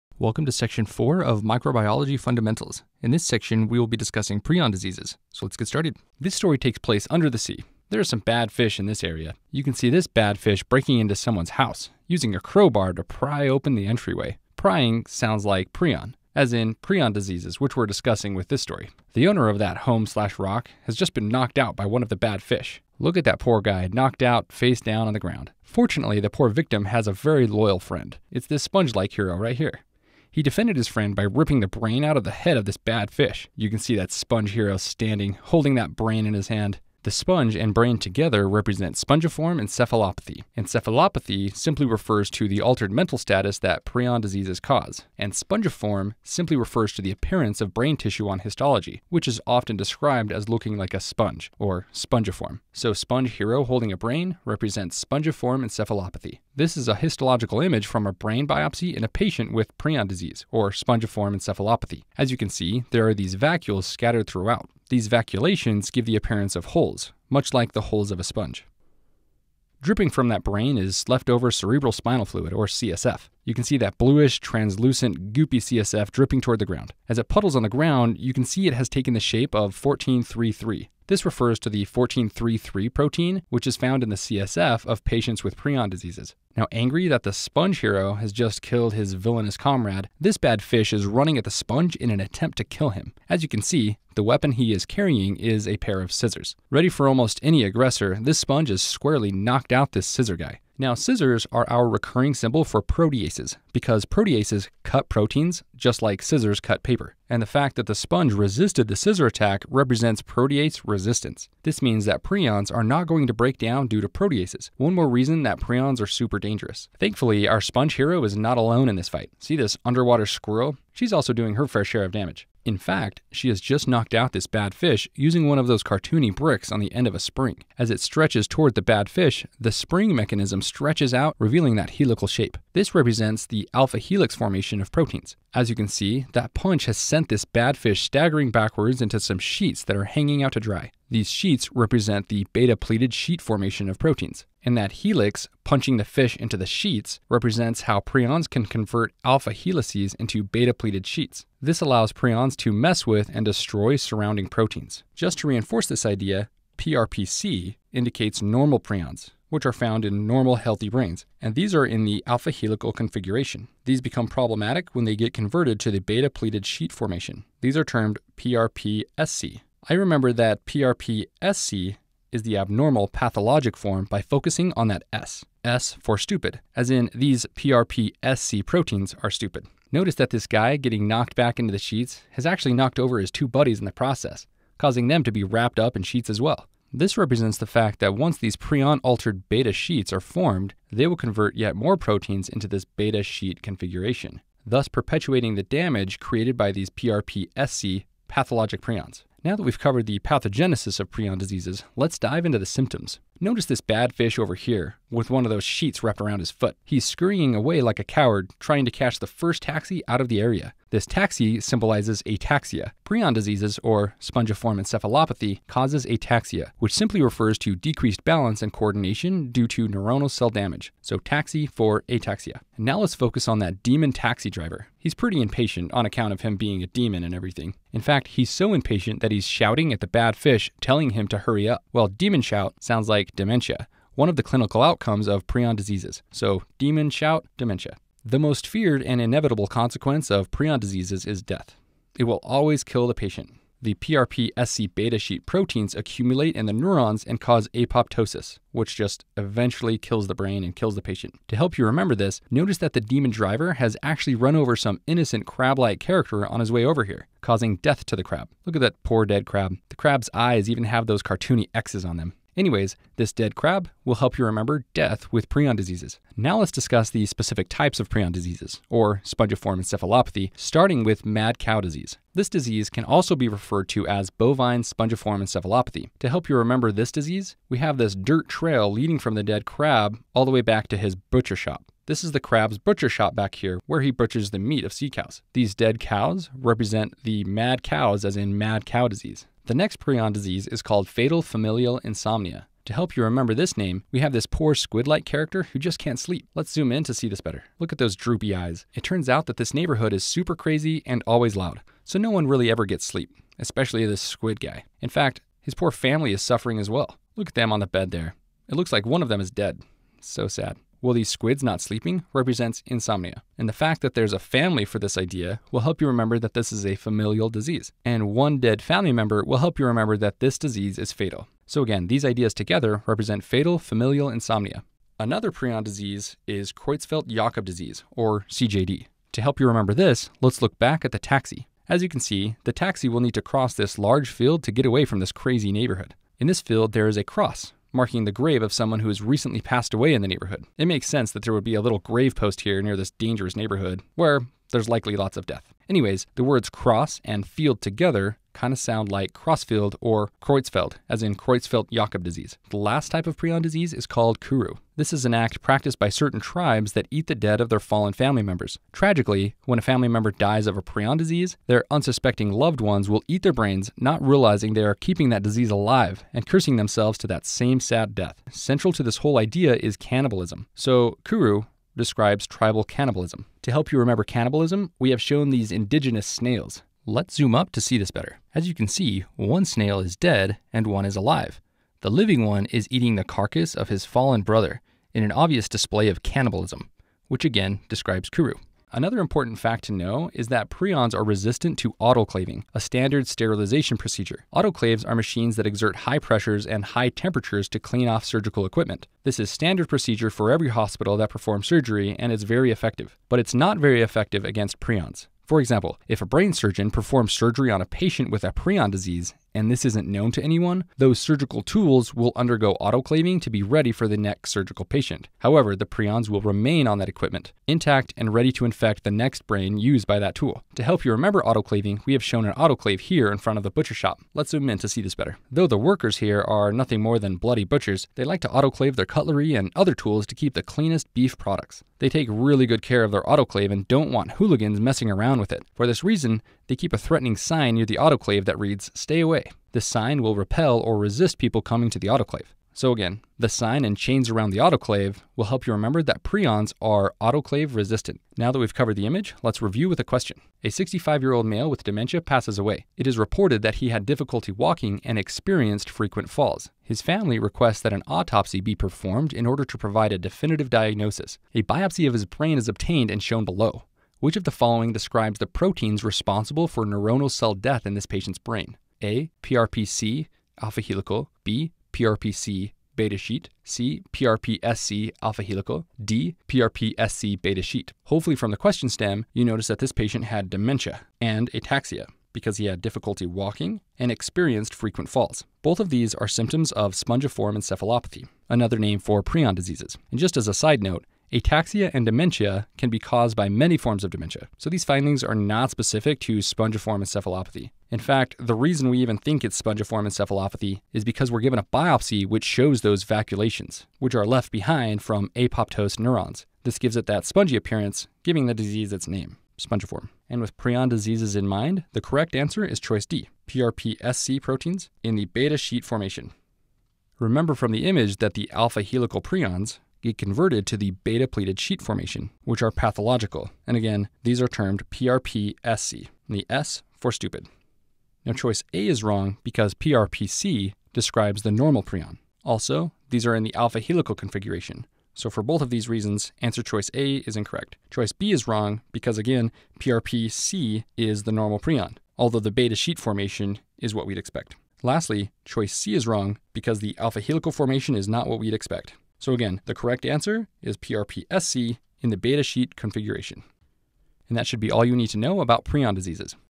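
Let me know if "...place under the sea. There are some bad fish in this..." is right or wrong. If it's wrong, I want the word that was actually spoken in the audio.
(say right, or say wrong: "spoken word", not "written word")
right.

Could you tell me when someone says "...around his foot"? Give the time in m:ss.
3:26.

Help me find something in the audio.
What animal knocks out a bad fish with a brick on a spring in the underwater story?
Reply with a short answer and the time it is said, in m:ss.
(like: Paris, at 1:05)
squirrel, at 1:59.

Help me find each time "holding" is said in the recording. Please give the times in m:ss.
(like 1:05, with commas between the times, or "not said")
0:35, 0:53.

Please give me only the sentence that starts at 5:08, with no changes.
It looks like one of them is dead.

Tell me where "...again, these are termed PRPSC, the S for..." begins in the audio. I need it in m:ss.
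8:43.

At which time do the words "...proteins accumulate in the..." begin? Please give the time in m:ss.
4:05.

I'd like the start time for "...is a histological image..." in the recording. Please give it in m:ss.
0:56.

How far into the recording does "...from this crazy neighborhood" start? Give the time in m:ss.
5:35.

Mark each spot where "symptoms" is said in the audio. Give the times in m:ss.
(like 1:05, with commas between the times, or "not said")
3:22, 8:06.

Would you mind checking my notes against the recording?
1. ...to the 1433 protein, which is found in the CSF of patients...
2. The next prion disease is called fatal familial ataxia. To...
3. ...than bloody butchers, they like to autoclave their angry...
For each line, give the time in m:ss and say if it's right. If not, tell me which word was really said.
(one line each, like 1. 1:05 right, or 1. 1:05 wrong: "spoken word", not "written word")
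1. 1:21 right
2. 4:49 wrong: "insomnia", not "ataxia"
3. 7:07 wrong: "cutlery", not "angry".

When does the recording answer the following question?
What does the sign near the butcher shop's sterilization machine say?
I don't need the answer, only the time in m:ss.
7:18.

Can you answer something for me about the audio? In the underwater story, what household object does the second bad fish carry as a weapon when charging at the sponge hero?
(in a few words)
a pair of scissors.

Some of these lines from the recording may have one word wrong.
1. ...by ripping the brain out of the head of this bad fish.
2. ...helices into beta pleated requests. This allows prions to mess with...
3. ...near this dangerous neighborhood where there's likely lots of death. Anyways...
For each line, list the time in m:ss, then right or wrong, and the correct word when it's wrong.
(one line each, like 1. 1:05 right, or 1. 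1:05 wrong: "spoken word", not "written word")
1. 0:31 right
2. 2:29 wrong: "sheets", not "requests"
3. 5:42 right.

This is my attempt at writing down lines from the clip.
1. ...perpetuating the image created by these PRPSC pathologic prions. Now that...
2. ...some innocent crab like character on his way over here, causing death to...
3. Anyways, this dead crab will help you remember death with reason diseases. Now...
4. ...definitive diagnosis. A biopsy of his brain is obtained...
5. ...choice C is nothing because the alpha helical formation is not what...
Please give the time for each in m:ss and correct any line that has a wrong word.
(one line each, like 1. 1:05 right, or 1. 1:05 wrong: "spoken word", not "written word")
1. 3:14 wrong: "damage", not "image"
2. 4:14 right
3. 4:22 wrong: "prion", not "reason"
4. 7:40 right
5. 9:05 wrong: "wrong", not "nothing".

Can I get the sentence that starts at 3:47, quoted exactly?
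In fact, he's so impatient that he's shouting at the bad fish, telling him to hurry up.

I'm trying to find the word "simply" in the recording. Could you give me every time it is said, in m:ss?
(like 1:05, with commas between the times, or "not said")
0:41, 0:46, 3:36.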